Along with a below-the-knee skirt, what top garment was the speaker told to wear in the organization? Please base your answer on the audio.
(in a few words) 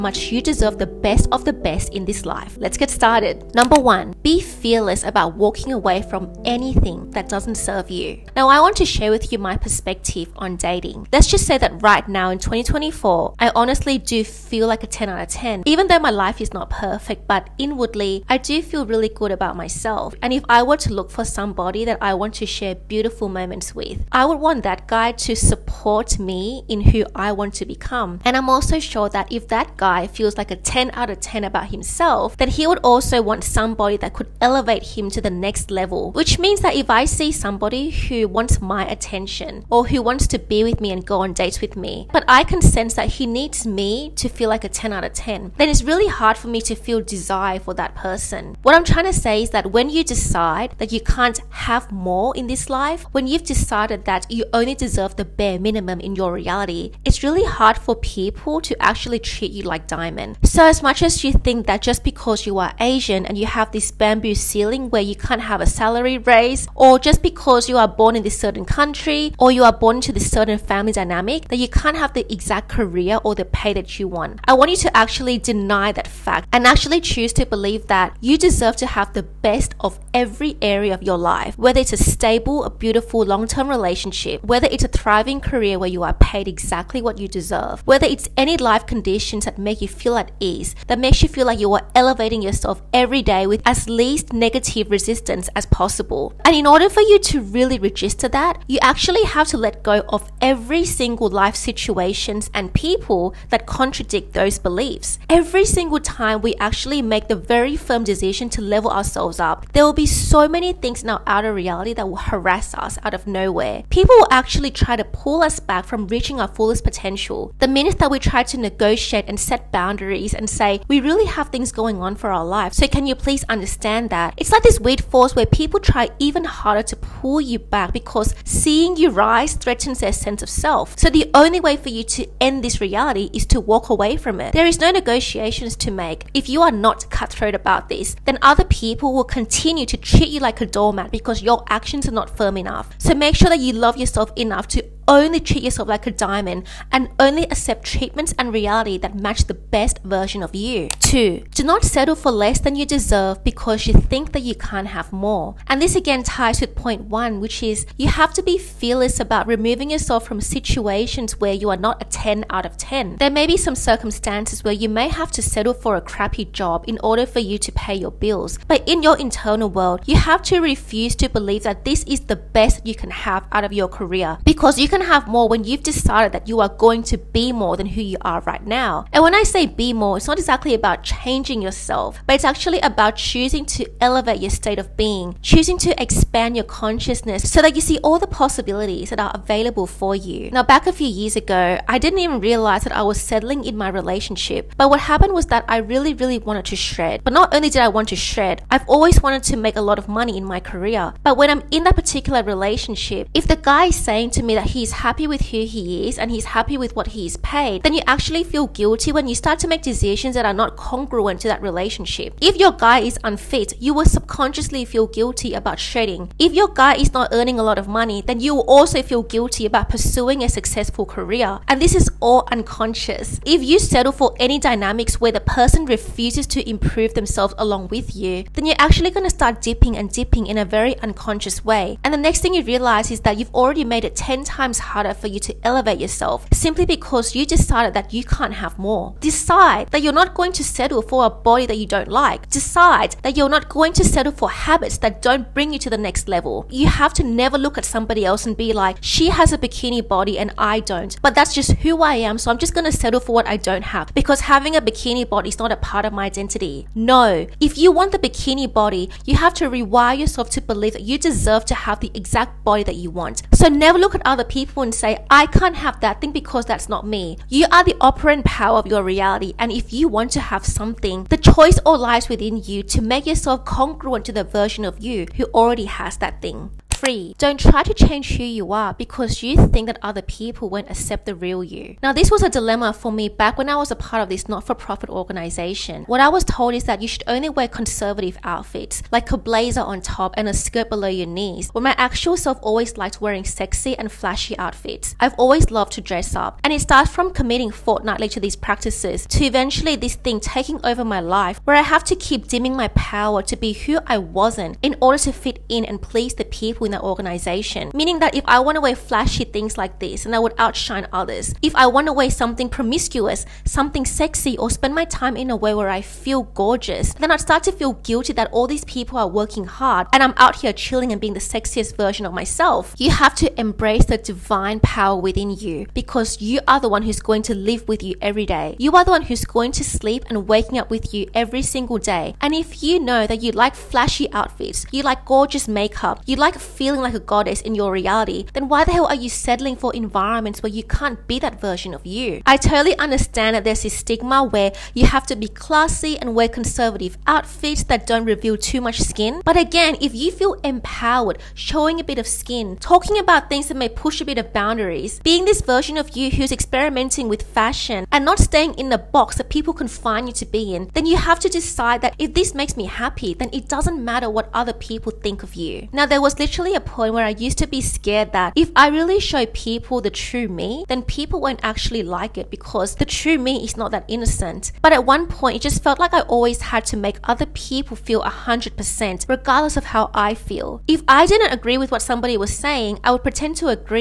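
blazer.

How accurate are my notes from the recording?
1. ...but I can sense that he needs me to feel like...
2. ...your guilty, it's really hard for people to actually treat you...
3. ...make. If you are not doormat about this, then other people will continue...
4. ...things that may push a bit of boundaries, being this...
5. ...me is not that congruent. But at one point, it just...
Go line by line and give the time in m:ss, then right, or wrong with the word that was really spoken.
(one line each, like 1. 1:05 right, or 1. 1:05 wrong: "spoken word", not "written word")
1. 0:42 right
2. 0:56 wrong: "reality", not "guilty"
3. 2:15 wrong: "cutthroat", not "doormat"
4. 5:53 right
5. 6:13 wrong: "innocent", not "congruent".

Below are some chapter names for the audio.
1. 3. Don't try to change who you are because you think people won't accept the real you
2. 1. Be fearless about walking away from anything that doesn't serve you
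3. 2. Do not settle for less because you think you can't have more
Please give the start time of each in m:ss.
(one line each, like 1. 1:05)
1. 4:40
2. 0:06
3. 2:37.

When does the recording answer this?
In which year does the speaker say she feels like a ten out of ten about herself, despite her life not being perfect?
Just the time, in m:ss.
0:12.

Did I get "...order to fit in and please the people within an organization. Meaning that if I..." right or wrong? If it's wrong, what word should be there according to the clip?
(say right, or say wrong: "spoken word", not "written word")
right.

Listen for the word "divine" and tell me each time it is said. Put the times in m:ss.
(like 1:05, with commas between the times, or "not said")
5:24.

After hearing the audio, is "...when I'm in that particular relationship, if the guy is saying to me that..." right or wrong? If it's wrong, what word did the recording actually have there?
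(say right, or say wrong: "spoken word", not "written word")
right.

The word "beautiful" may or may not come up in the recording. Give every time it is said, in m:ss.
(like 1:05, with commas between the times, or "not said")
0:22, 1:22.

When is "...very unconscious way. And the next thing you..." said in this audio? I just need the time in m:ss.
3:50.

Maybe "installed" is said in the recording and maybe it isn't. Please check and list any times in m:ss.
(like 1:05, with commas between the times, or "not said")
not said.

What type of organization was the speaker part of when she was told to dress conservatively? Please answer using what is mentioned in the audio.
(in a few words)
not for profit.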